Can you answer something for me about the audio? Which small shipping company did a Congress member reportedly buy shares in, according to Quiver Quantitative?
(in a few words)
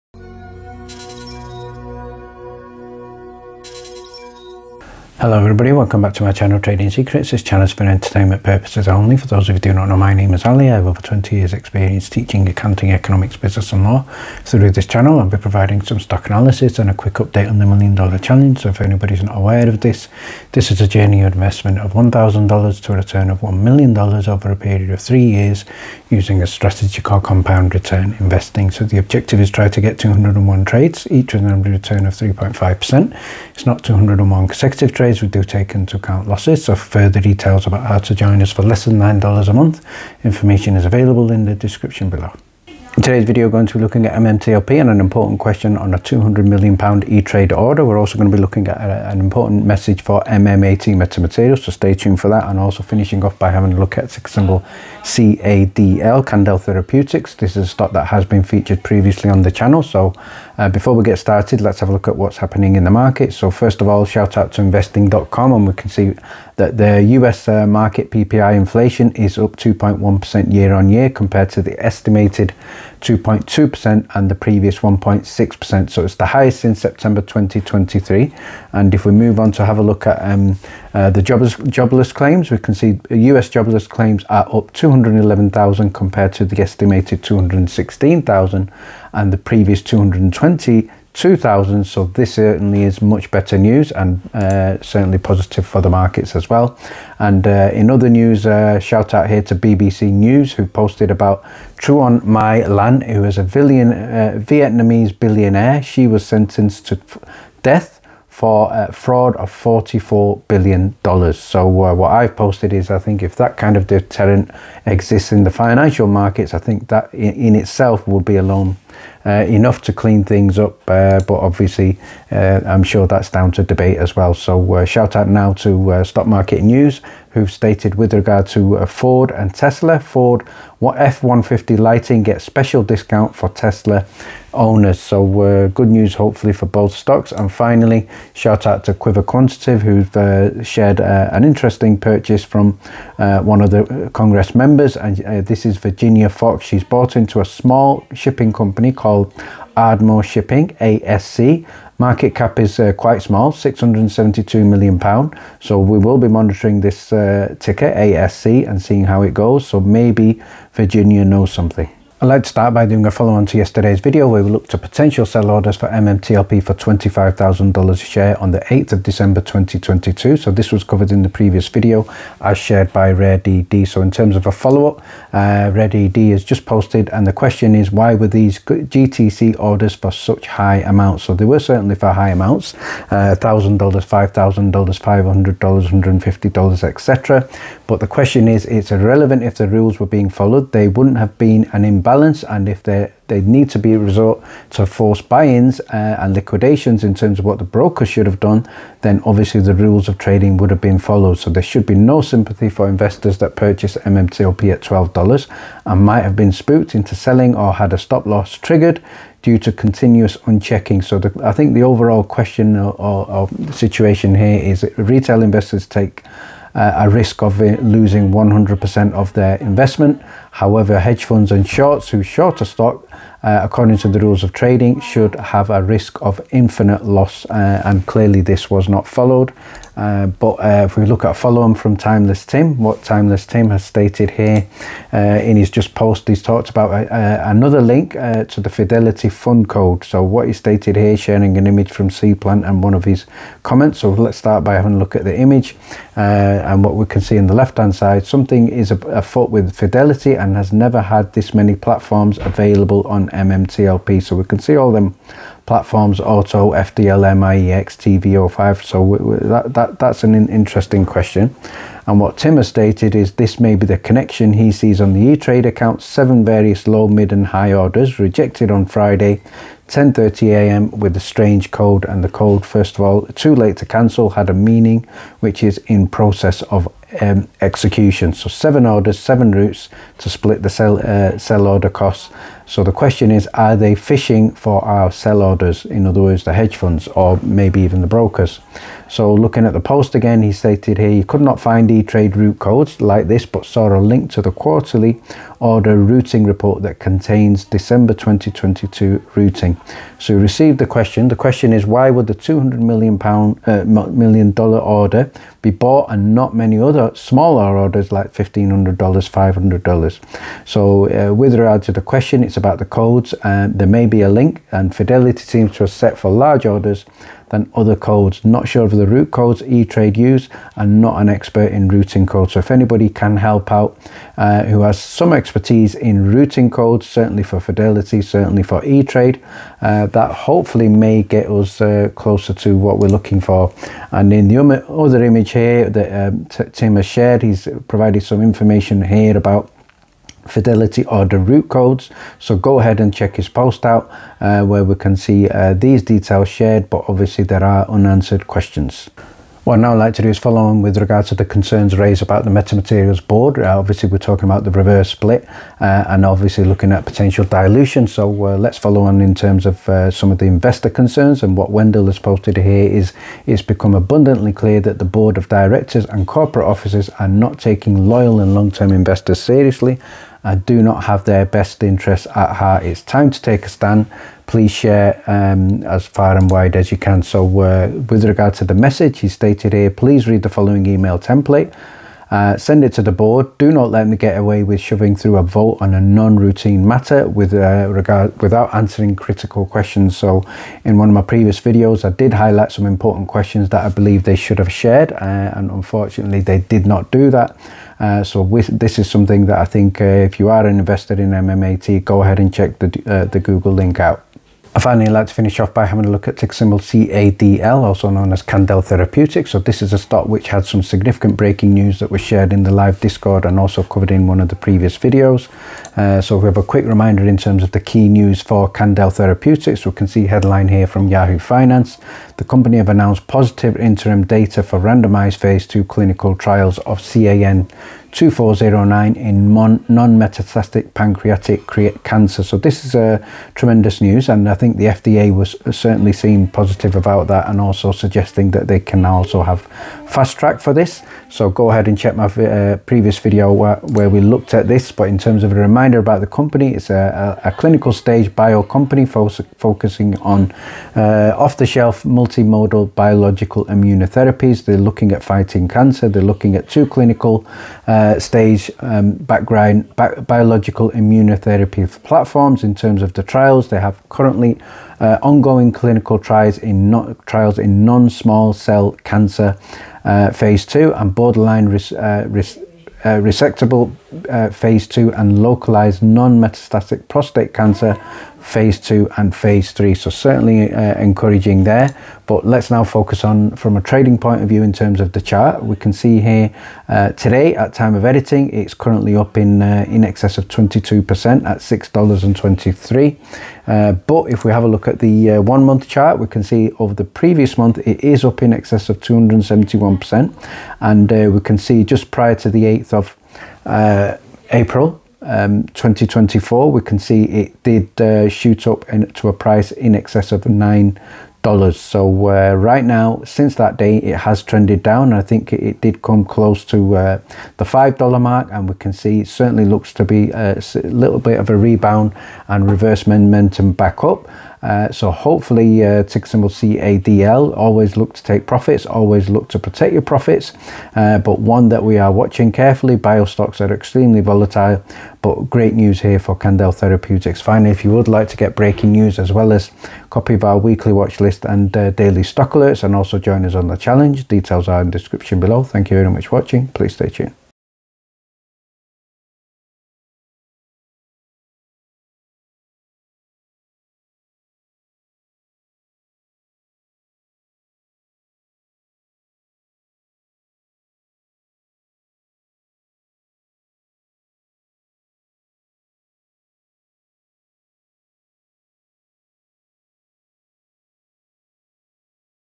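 Ardmore Shipping.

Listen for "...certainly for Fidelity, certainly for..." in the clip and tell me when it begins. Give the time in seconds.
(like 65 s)
327 s.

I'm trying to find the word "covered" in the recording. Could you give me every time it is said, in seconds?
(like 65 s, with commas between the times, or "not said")
170 s, 413 s.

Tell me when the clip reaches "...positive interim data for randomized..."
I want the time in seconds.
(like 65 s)
423 s.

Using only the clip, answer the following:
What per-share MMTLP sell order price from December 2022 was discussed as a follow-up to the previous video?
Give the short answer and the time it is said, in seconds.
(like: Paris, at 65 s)
$25,000, at 166 s.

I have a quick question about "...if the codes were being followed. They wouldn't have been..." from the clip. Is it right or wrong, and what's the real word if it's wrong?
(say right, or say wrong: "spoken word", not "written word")
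wrong: "rules", not "codes".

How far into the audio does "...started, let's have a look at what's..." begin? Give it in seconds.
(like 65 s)
61 s.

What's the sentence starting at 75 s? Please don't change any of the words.
So it's the highest since September 2023.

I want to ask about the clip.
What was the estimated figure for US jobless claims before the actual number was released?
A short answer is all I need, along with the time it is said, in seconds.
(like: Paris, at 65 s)
216,000, at 87 s.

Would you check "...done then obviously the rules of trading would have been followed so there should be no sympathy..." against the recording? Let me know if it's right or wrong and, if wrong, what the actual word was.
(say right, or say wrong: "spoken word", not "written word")
right.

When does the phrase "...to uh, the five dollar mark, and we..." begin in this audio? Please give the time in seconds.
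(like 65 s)
516 s.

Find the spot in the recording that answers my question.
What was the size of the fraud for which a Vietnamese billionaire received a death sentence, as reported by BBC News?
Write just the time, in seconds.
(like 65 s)
109 s.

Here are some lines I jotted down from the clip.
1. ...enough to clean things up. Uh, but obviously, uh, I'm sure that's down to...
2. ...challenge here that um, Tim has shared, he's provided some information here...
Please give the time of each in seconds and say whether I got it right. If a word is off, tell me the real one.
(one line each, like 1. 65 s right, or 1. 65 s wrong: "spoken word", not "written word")
1. 119 s right
2. 335 s wrong: "image", not "challenge".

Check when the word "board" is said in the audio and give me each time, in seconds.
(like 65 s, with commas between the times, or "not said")
353 s, 365 s, 383 s.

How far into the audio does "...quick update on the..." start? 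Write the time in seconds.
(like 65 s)
16 s.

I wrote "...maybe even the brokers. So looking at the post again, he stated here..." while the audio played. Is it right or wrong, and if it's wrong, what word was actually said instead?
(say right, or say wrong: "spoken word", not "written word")
right.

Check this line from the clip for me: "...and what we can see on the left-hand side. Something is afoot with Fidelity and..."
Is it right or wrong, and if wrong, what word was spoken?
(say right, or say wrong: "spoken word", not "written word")
right.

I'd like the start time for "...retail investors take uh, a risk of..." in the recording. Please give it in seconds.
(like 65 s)
214 s.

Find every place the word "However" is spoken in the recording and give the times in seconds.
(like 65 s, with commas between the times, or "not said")
220 s.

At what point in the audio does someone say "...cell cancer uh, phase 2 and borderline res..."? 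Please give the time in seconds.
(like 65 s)
468 s.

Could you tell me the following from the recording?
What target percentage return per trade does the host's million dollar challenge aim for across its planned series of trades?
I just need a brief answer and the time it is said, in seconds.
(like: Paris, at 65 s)
3.5%, at 32 s.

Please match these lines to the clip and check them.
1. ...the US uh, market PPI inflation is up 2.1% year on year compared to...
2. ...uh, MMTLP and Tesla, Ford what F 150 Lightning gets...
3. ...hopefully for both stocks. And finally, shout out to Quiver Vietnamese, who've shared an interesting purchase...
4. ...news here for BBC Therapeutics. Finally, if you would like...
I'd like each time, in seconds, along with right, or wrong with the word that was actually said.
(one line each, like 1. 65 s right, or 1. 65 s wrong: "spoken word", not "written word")
1. 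66 s right
2. 128 s wrong: "Ford", not "MMTLP"
3. 136 s wrong: "Quantitative", not "Vietnamese"
4. 535 s wrong: "Candel", not "BBC".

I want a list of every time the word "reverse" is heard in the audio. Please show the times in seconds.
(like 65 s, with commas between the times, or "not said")
354 s, 522 s.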